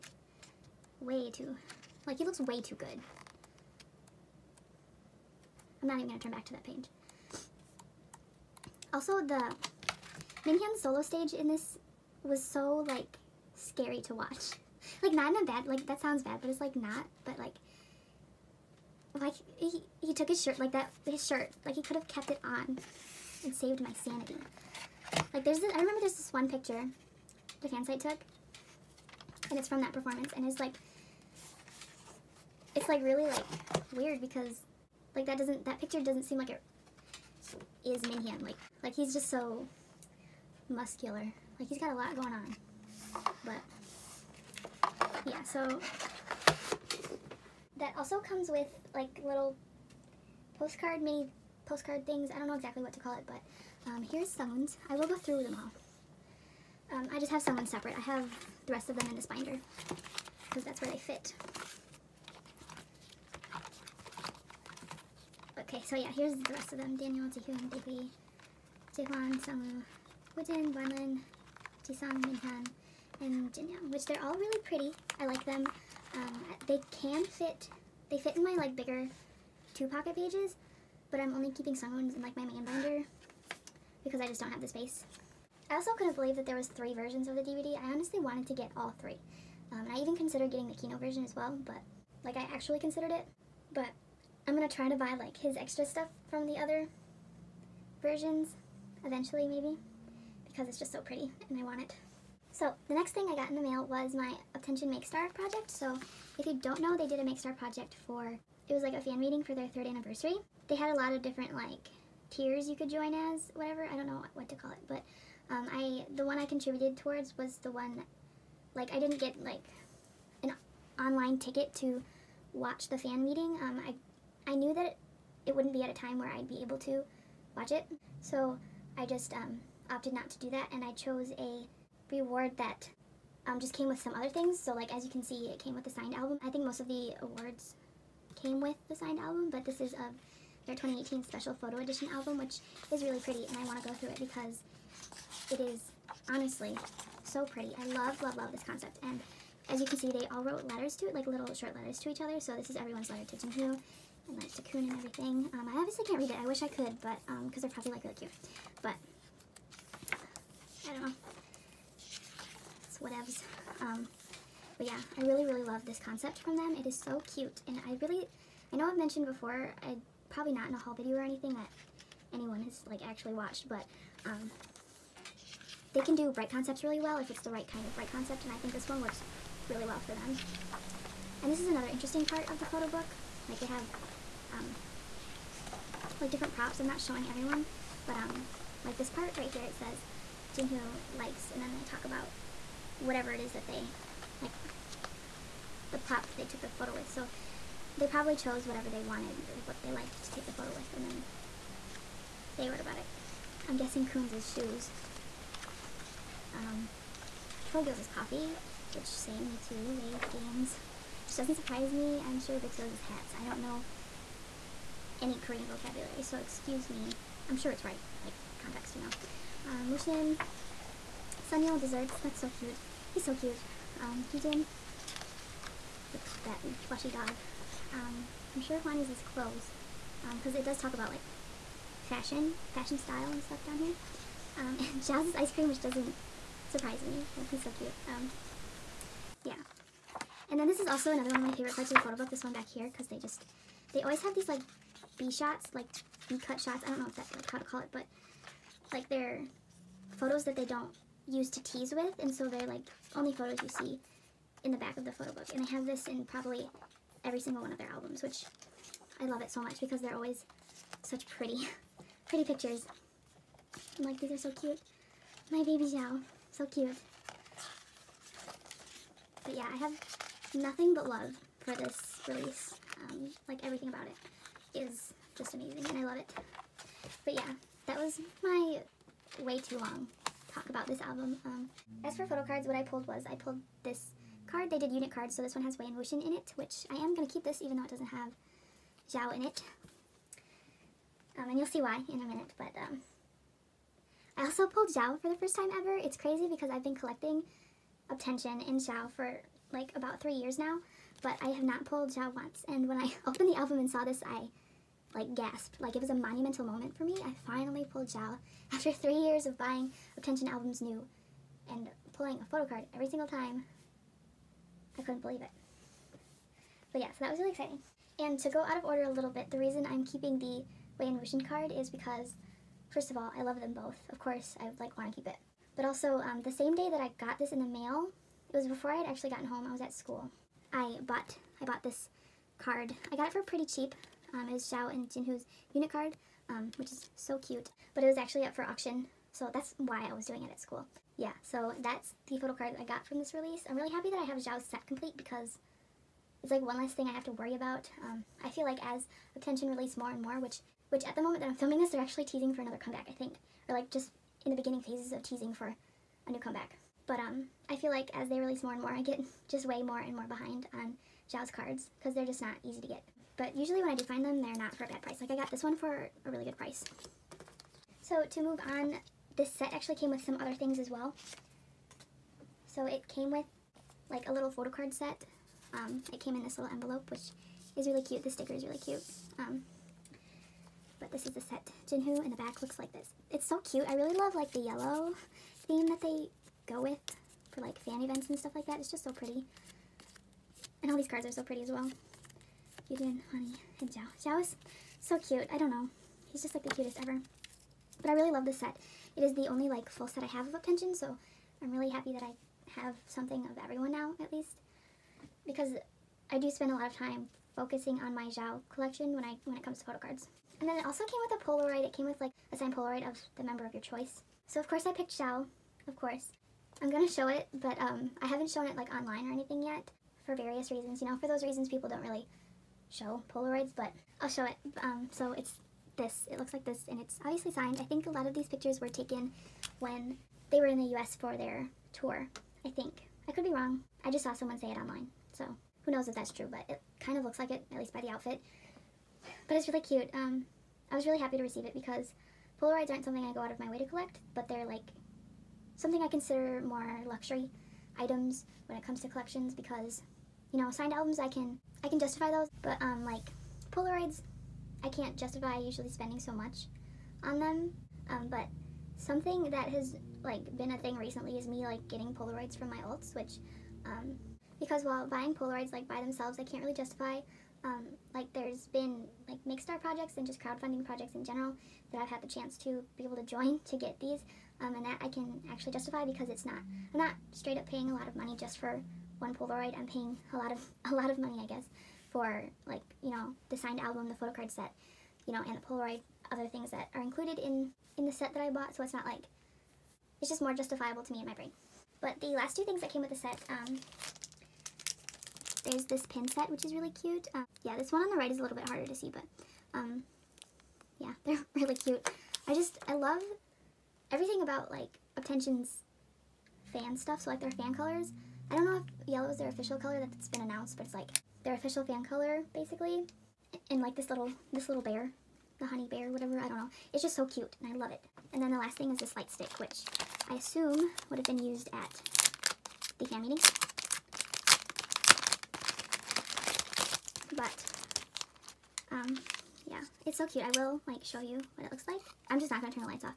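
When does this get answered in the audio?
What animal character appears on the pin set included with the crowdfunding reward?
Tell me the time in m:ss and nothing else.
8:35.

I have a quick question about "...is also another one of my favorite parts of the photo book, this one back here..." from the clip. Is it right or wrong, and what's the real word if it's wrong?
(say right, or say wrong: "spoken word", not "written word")
right.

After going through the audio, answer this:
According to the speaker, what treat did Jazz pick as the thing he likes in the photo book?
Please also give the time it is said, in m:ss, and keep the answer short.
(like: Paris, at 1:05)
Ice cream, at 3:55.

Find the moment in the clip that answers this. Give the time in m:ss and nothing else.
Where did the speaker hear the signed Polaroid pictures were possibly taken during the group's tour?
7:10.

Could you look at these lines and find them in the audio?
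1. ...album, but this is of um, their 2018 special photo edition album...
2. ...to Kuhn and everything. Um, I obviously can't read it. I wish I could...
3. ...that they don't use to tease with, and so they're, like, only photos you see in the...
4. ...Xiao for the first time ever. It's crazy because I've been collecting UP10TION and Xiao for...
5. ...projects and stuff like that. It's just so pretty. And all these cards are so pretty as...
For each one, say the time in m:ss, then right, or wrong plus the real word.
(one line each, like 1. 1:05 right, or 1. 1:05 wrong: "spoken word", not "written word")
1. 2:19 right
2. 2:34 right
3. 4:10 right
4. 4:54 right
5. 6:28 wrong: "events", not "projects".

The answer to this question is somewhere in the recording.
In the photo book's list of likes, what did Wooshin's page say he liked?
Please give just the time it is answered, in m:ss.
3:41.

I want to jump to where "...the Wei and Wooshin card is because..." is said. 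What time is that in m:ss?
5:20.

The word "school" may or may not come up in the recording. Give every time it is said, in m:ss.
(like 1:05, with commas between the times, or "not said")
5:29, 5:40.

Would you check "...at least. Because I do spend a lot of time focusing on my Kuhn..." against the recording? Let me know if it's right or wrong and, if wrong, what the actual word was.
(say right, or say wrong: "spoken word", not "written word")
wrong: "Xiao", not "Kuhn".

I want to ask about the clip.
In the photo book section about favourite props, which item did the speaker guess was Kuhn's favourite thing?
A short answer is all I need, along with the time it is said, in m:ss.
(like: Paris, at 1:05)
Shoes, at 3:24.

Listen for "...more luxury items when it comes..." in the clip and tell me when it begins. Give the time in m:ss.
7:26.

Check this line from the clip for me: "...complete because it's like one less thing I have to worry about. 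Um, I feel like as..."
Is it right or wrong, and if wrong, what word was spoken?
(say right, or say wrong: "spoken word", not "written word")
right.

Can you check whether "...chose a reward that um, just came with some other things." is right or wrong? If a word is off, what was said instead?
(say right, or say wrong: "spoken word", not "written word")
right.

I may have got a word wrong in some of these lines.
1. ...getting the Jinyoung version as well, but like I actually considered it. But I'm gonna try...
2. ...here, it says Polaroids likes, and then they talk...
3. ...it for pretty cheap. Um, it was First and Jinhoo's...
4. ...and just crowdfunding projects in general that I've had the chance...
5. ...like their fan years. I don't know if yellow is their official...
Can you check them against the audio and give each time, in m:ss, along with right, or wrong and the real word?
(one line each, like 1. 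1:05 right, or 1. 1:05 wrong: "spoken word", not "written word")
1. 1:30 wrong: "Kino", not "Jinyoung"
2. 3:09 wrong: "Jinhoo", not "Polaroids"
3. 5:33 wrong: "Xiao", not "First"
4. 7:50 right
5. 8:27 wrong: "colors", not "years".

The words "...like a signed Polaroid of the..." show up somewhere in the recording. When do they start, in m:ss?
6:52.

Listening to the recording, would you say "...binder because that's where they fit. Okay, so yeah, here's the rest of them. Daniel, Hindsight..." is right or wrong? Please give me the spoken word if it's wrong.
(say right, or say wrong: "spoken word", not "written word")
wrong: "Jihoon", not "Hindsight".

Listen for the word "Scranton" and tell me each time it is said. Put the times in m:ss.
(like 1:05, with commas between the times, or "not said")
not said.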